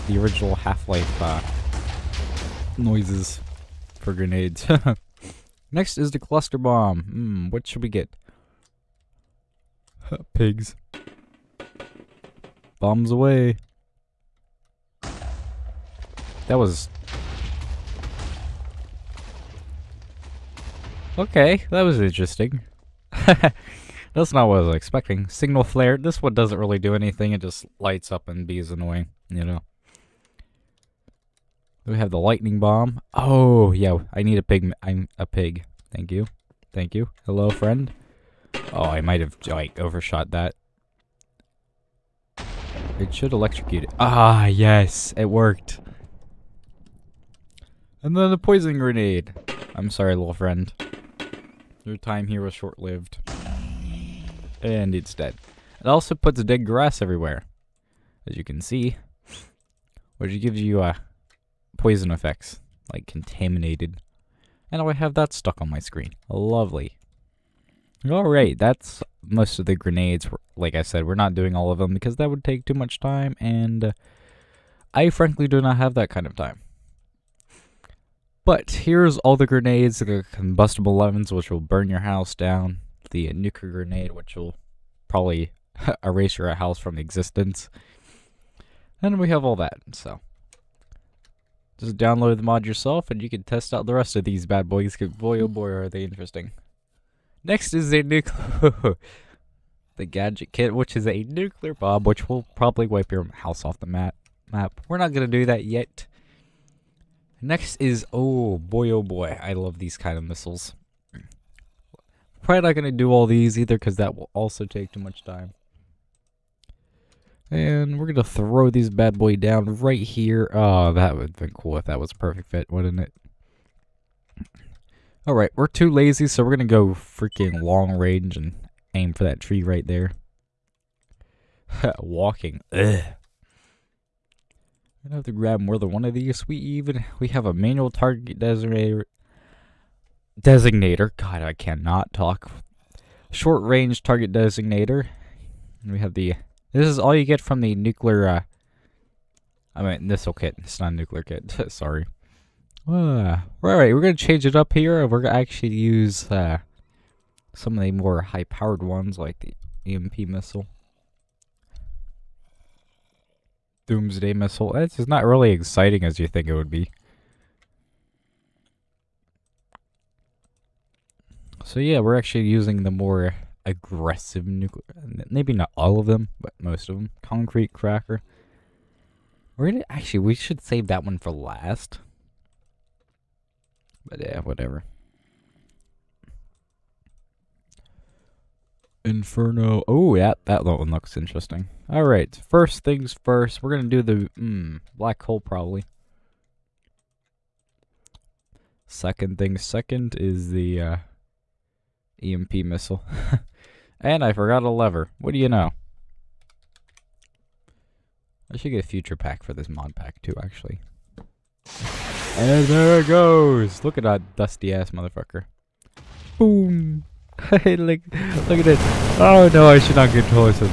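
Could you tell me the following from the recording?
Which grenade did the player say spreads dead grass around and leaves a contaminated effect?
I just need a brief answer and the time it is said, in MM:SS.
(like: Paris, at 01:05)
Poison grenade, at 00:48.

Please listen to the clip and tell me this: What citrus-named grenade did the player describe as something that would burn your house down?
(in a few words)
Combustible lemons.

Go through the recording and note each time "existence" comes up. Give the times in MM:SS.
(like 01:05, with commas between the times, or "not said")
01:26.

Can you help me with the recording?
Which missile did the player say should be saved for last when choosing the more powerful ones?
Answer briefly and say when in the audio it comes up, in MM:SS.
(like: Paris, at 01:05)
Concrete cracker, at 02:57.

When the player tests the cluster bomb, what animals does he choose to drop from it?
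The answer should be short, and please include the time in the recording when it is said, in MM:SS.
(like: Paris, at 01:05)
Pigs, at 00:10.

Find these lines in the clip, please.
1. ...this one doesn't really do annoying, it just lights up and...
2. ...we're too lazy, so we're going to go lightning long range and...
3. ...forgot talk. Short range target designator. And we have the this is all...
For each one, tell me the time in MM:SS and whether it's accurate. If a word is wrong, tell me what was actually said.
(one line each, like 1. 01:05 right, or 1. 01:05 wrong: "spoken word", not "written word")
1. 00:25 wrong: "anything", not "annoying"
2. 02:05 wrong: "freaking", not "lightning"
3. 02:21 wrong: "cannot", not "forgot".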